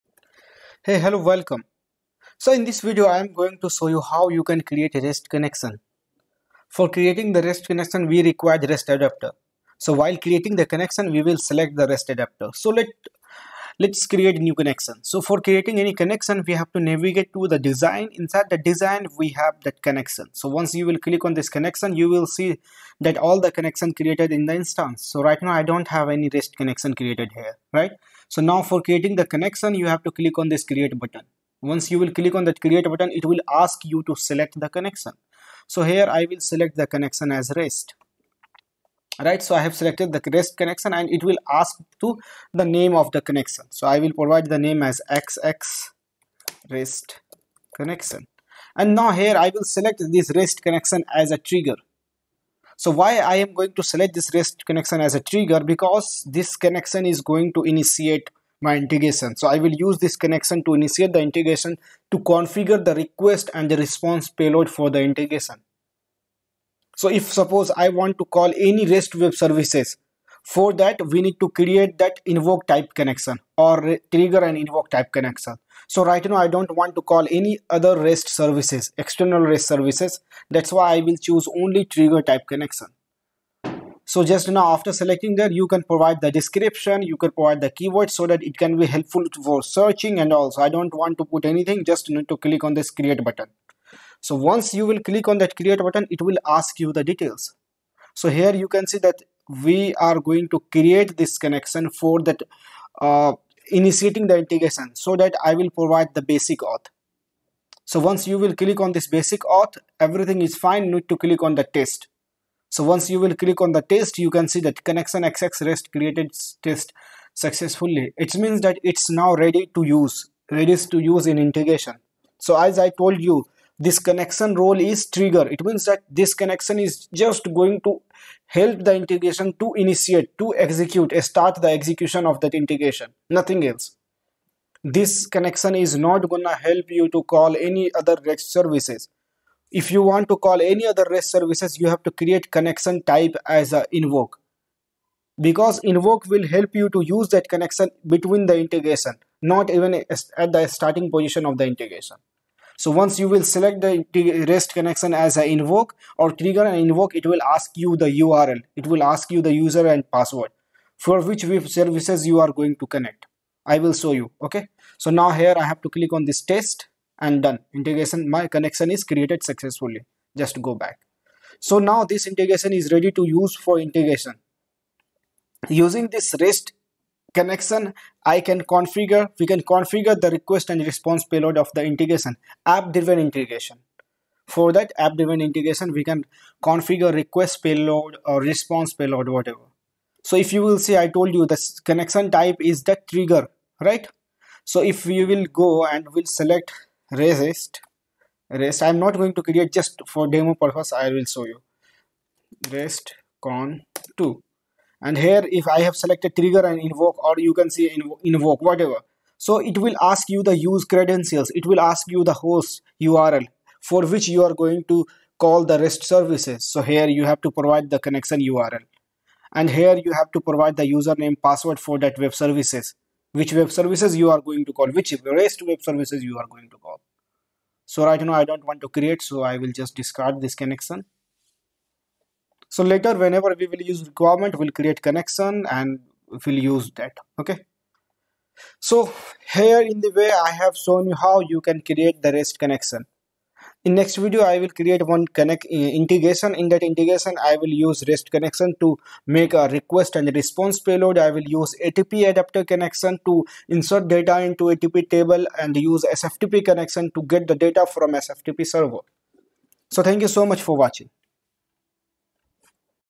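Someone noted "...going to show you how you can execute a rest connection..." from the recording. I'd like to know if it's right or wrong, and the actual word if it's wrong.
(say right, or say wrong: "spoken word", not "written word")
wrong: "create", not "execute".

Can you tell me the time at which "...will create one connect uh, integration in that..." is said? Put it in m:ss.
4:04.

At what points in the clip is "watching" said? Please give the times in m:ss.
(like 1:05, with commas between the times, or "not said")
4:20.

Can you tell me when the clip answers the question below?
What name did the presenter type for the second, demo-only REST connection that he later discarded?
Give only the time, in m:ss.
3:22.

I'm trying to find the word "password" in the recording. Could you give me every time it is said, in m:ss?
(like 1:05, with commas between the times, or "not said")
2:40, 3:41.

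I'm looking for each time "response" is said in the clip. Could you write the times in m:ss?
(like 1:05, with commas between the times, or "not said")
1:03, 3:00, 3:08, 4:10.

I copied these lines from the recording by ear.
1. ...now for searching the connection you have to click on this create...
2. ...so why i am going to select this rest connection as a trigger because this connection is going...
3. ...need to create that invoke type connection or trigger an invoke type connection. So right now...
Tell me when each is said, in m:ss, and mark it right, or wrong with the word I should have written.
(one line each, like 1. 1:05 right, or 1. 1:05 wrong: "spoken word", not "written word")
1. 0:28 wrong: "creating", not "searching"
2. 0:52 right
3. 1:11 right.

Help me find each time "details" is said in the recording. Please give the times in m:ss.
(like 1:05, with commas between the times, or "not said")
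1:37.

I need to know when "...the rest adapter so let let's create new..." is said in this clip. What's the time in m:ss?
0:11.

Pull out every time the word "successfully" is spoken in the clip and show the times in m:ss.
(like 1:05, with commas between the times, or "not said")
1:57, 2:49.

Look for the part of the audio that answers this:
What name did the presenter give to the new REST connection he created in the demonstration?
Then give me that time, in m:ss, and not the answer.
0:45.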